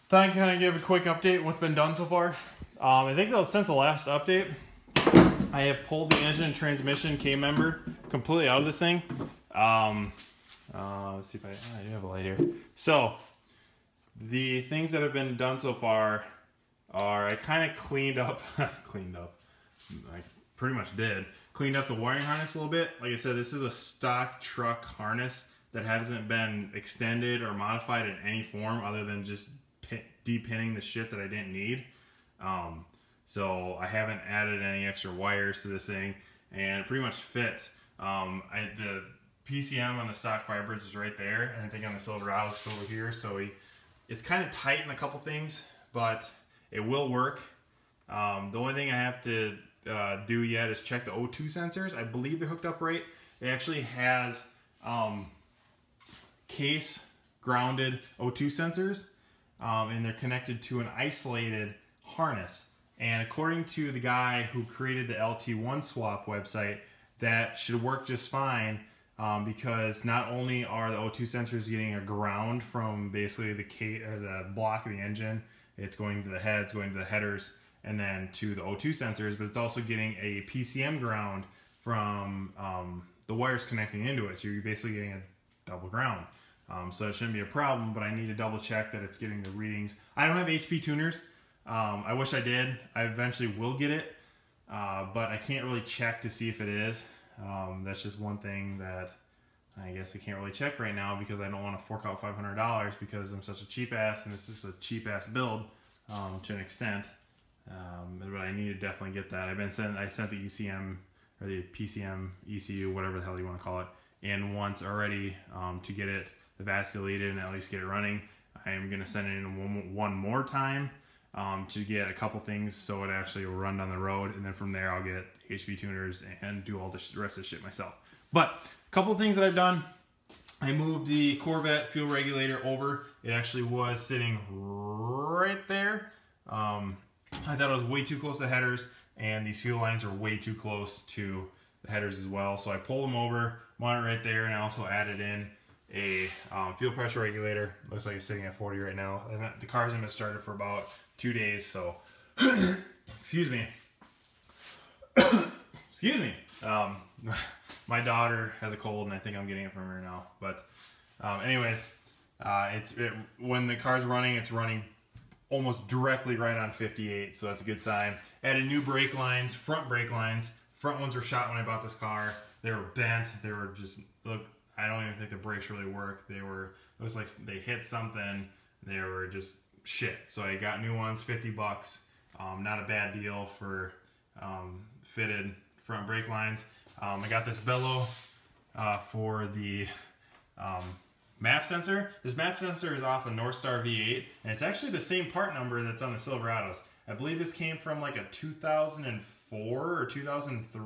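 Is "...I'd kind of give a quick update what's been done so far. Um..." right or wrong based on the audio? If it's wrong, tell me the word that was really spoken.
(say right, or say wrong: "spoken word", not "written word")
right.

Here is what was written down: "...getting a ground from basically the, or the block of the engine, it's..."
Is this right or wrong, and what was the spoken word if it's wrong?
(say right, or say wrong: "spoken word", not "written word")
right.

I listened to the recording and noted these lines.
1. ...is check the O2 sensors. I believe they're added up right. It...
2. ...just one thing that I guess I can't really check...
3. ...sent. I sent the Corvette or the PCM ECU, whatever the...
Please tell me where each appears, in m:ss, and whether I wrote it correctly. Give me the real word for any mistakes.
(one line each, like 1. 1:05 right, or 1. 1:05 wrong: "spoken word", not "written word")
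1. 0:50 wrong: "hooked", not "added"
2. 1:38 right
3. 1:49 wrong: "ECM", not "Corvette".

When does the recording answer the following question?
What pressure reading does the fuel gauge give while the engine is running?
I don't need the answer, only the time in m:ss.
2:46.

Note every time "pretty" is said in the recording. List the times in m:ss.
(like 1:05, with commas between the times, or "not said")
0:20, 0:36.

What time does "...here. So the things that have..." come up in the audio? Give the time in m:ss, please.
0:12.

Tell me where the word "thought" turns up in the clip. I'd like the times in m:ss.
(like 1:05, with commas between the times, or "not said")
0:00, 2:17.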